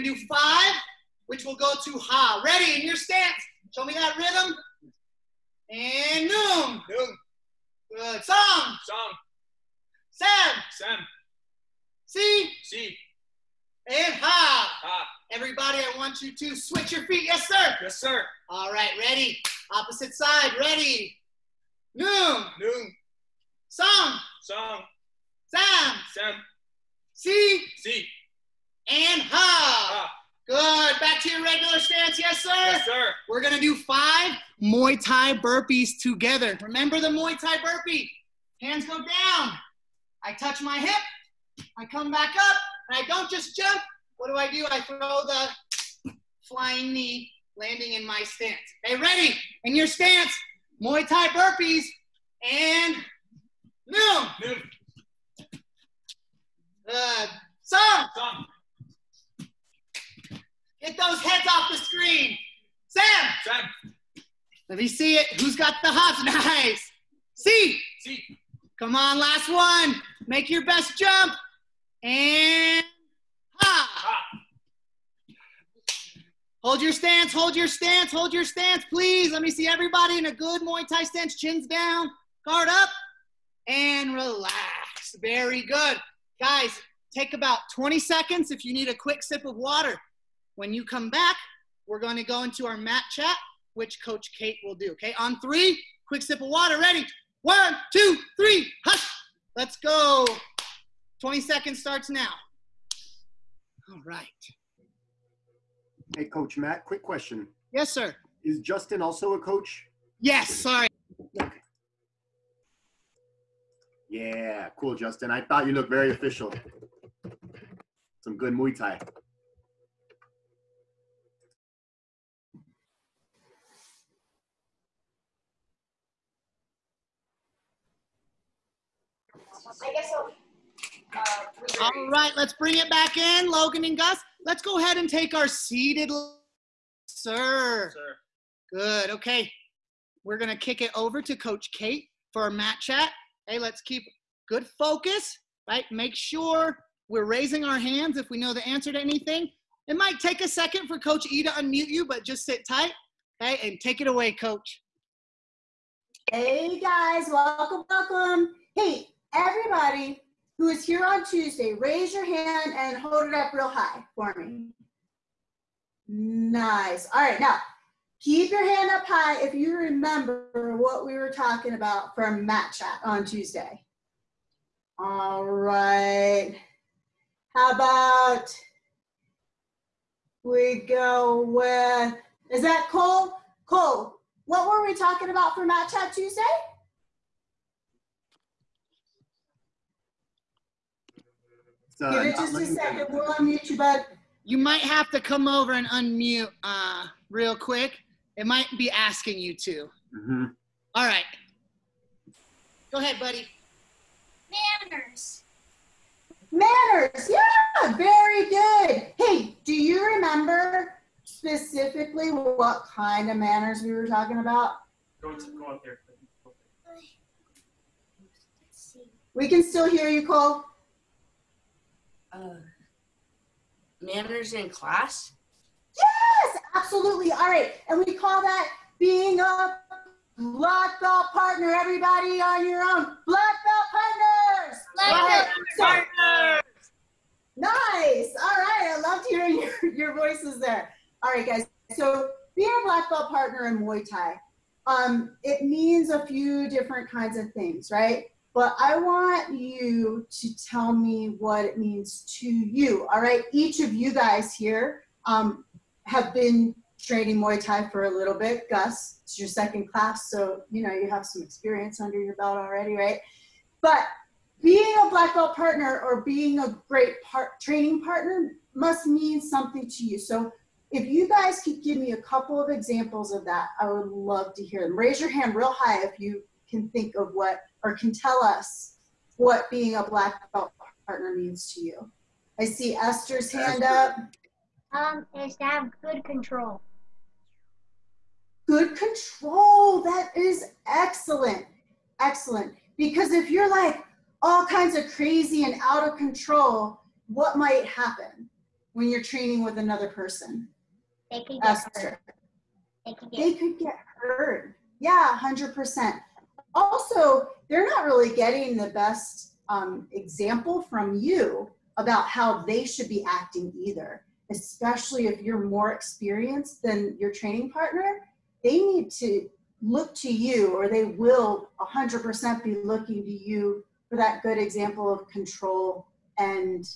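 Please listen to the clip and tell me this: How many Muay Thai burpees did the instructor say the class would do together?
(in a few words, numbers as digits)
5.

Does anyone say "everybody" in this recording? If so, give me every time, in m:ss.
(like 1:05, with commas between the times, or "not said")
0:15, 1:19, 2:39, 3:51.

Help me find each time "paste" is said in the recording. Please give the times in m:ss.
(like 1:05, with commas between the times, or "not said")
not said.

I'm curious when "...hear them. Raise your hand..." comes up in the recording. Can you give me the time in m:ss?
4:34.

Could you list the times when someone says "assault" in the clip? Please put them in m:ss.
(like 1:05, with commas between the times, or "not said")
not said.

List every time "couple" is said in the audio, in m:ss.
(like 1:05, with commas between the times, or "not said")
4:32.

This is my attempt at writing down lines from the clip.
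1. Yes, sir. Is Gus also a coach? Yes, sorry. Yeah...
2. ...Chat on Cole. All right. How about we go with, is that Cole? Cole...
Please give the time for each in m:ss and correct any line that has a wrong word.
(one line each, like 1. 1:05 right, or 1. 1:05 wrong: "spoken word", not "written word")
1. 1:47 wrong: "Justin", not "Gus"
2. 2:52 wrong: "Tuesday", not "Cole".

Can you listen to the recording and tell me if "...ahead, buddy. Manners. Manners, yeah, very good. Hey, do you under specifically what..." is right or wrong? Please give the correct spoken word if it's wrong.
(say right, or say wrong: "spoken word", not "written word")
wrong: "remember", not "under".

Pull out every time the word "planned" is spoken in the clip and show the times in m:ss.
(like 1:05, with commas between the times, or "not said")
not said.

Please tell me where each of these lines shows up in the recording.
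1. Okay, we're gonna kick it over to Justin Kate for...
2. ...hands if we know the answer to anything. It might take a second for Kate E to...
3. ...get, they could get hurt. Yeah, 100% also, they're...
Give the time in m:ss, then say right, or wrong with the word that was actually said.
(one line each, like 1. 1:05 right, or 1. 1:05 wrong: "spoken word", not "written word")
1. 2:19 wrong: "Coach", not "Justin"
2. 2:27 wrong: "Coach", not "Kate"
3. 5:03 right.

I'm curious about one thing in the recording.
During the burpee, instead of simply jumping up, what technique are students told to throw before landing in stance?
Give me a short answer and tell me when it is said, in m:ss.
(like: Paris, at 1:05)
flying knee, at 0:46.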